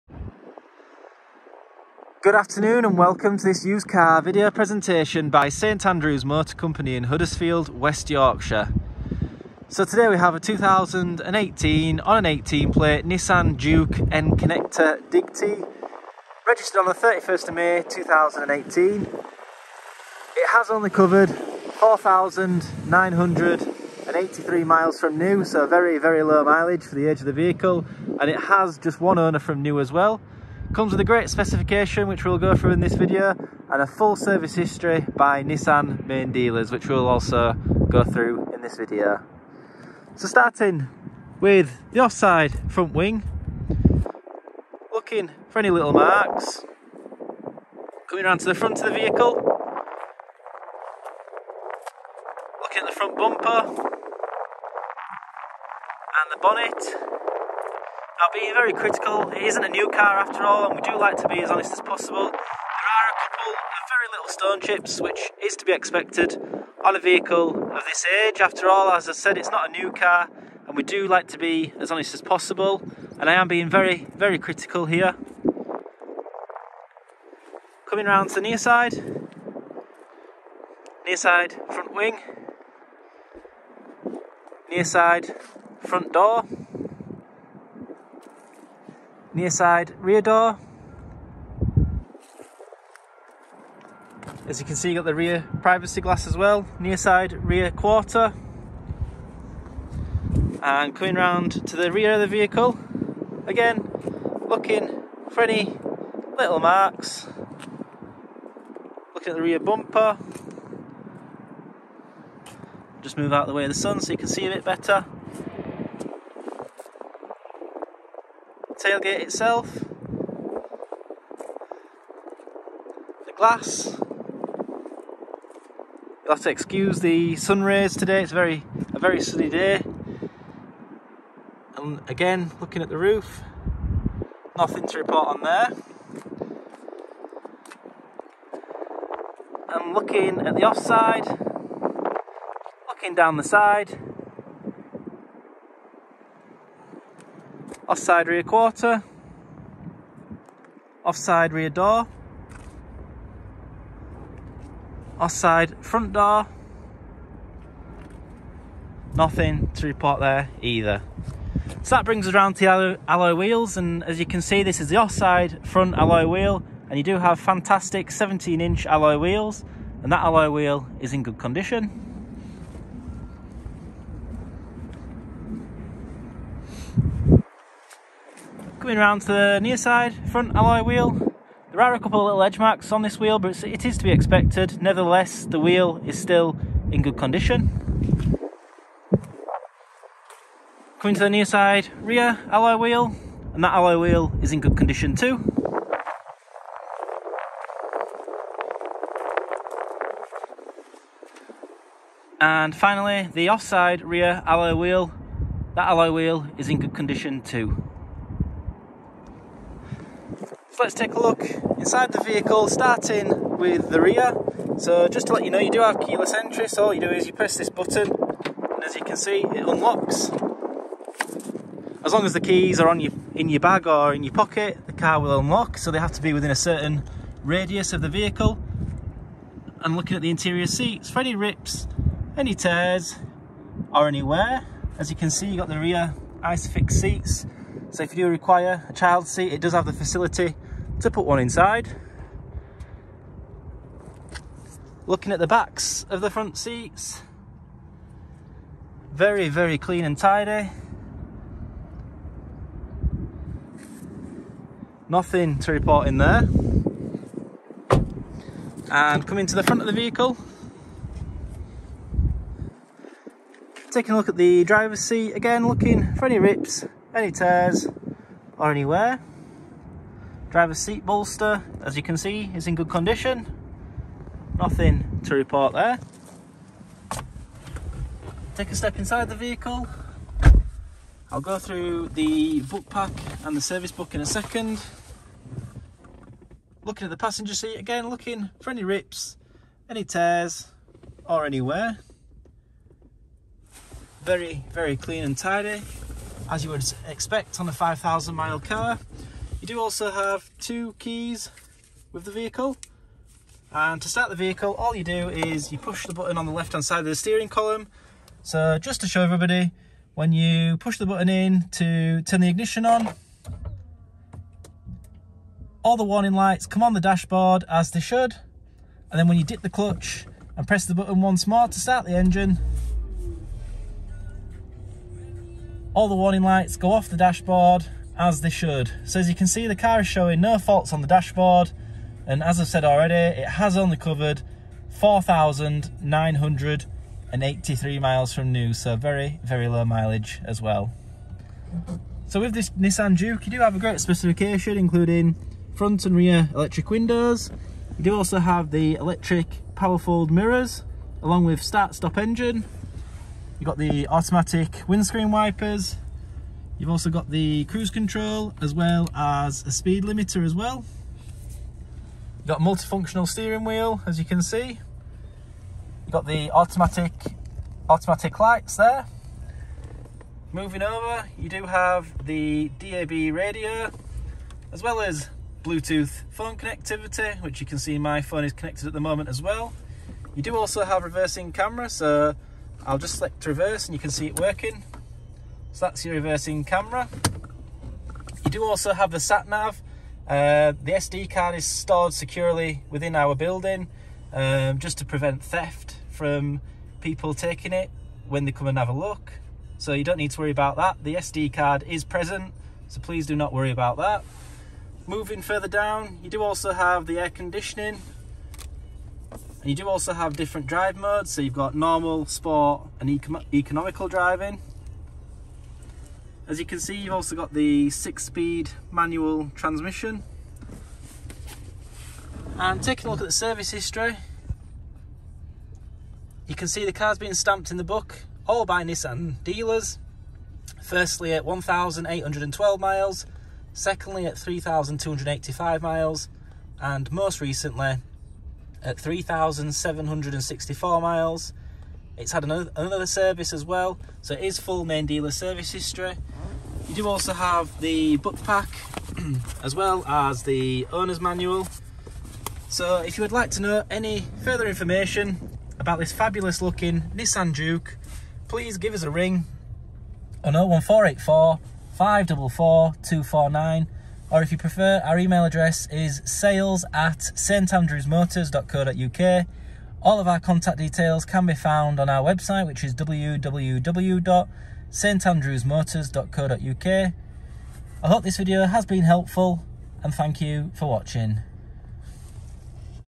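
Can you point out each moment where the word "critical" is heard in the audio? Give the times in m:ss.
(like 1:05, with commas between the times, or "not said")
0:58, 1:14.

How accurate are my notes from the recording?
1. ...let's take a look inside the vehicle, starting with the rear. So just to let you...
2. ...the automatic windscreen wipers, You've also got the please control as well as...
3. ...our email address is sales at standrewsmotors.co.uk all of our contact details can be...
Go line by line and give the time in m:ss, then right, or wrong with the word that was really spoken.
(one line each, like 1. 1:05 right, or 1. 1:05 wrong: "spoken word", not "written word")
1. 3:30 right
2. 5:53 wrong: "cruise", not "please"
3. 7:45 right.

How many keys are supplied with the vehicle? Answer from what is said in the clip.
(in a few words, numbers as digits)
2.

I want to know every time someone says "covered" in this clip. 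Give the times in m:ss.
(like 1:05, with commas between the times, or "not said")
0:20, 5:33.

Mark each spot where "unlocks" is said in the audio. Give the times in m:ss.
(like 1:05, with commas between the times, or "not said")
3:39, 3:45.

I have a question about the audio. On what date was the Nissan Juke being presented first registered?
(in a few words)
31 May 2018.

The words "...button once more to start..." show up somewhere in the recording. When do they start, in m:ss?
5:20.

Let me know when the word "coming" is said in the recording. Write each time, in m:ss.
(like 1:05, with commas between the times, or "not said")
0:48, 1:17, 1:40, 2:58, 3:10, 4:19.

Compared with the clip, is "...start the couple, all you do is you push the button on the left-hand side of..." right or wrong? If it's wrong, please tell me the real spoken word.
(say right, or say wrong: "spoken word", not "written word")
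wrong: "vehicle", not "couple".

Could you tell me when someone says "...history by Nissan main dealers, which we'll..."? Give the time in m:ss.
0:34.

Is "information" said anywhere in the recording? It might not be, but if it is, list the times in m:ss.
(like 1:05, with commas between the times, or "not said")
7:34.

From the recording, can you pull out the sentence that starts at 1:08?
After all, as I said, it's not a new car, and we do like to be as honest as possible.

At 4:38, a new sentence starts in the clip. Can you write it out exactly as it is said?
Take a step inside the vehicle.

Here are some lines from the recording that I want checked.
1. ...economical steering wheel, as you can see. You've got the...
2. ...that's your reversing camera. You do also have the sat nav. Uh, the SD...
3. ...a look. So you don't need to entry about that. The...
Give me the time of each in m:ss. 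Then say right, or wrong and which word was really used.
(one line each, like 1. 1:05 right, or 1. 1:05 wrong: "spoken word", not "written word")
1. 6:02 wrong: "multifunctional", not "economical"
2. 6:25 right
3. 6:38 wrong: "worry", not "entry".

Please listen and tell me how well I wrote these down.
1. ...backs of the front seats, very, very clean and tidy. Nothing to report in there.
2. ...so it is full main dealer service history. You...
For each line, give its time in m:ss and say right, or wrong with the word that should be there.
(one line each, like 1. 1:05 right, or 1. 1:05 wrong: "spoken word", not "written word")
1. 4:05 right
2. 7:24 right.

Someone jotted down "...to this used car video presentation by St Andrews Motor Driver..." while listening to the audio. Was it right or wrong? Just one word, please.
wrong.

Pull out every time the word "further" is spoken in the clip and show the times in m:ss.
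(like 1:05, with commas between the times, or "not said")
6:45, 7:34.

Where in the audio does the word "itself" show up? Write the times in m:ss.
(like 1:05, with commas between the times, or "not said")
1:59.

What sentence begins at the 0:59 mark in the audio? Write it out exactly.
It isn't a new car after all, and we do like to be as honest as possible.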